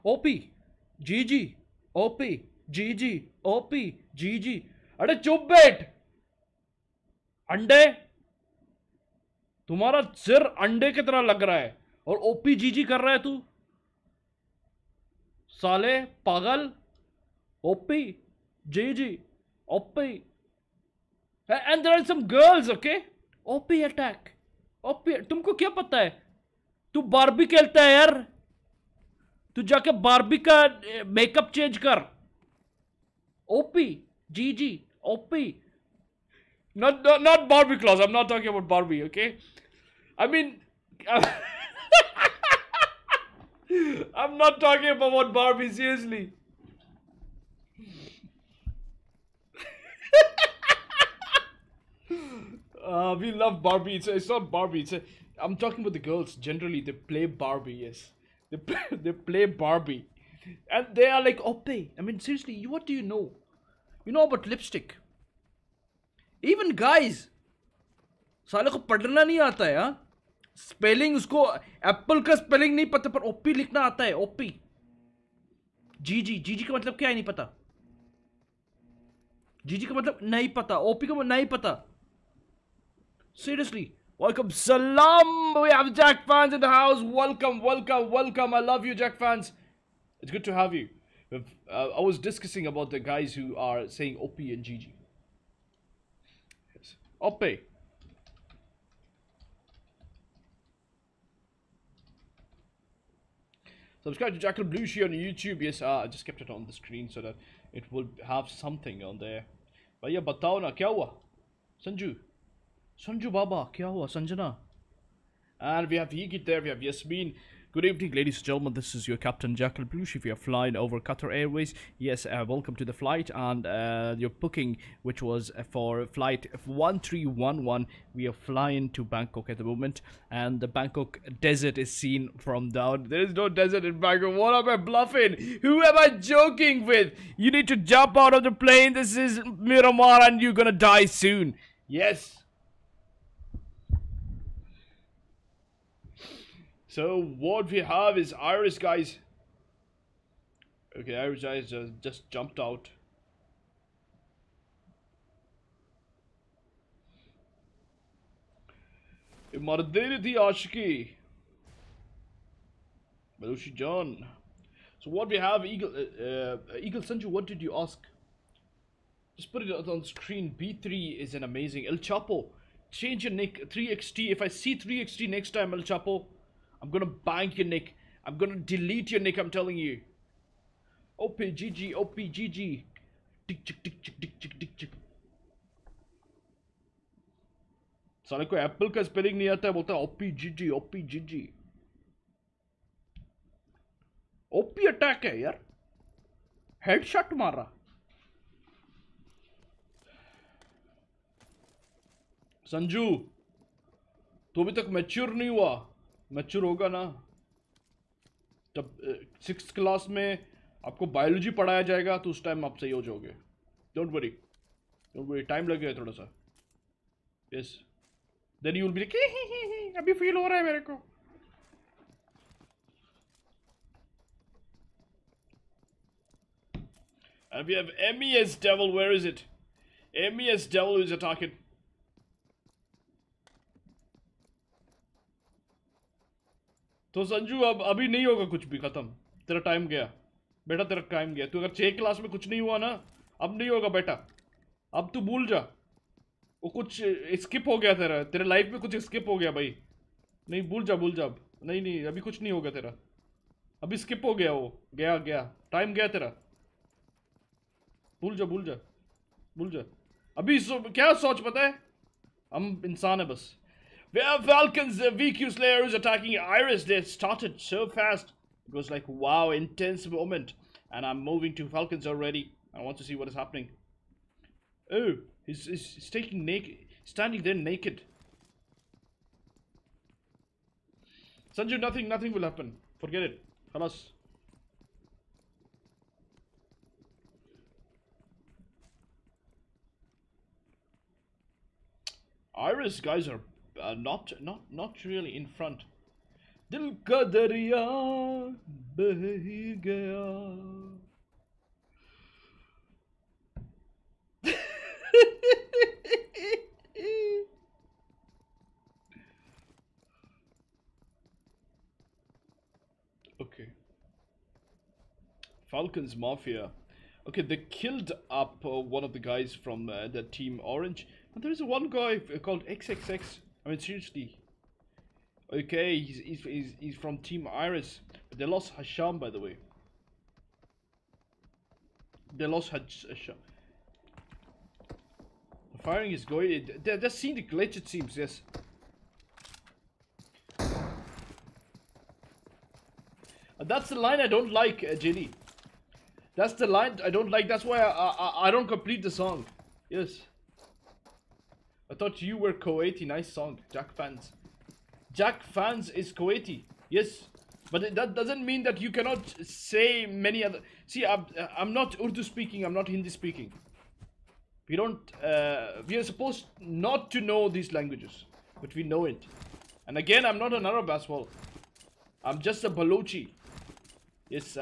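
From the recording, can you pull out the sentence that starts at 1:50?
But yeah, batao na, kya hua?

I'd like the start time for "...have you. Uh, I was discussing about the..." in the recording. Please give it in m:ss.
1:30.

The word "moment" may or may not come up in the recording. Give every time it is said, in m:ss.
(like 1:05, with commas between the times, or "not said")
2:09, 4:30.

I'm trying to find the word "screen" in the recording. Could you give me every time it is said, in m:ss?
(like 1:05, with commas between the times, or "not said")
1:46, 2:50.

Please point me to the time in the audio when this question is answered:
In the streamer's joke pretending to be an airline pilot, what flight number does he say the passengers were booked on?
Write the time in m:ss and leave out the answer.
2:06.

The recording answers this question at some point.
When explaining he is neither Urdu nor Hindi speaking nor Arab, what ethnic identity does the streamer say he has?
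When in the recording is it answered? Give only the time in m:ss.
6:12.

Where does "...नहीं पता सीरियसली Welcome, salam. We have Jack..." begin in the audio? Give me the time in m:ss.
1:21.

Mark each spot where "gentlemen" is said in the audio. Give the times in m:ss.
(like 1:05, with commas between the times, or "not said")
1:58.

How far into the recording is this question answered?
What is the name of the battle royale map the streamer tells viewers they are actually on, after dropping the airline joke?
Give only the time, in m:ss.
2:19.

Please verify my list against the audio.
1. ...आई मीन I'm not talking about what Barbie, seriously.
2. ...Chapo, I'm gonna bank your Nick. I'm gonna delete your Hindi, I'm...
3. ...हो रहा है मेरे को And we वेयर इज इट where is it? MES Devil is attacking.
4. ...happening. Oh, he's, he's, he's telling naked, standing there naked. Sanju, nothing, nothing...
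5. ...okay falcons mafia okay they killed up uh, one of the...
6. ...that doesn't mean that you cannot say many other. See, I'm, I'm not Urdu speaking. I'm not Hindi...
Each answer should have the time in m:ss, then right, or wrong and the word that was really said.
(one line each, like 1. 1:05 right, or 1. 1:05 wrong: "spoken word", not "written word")
1. 0:40 right
2. 2:55 wrong: "Nick", not "Hindi"
3. 3:40 right
4. 4:33 wrong: "taking", not "telling"
5. 5:13 right
6. 5:57 right.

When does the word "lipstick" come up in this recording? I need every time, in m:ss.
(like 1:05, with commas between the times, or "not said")
1:04.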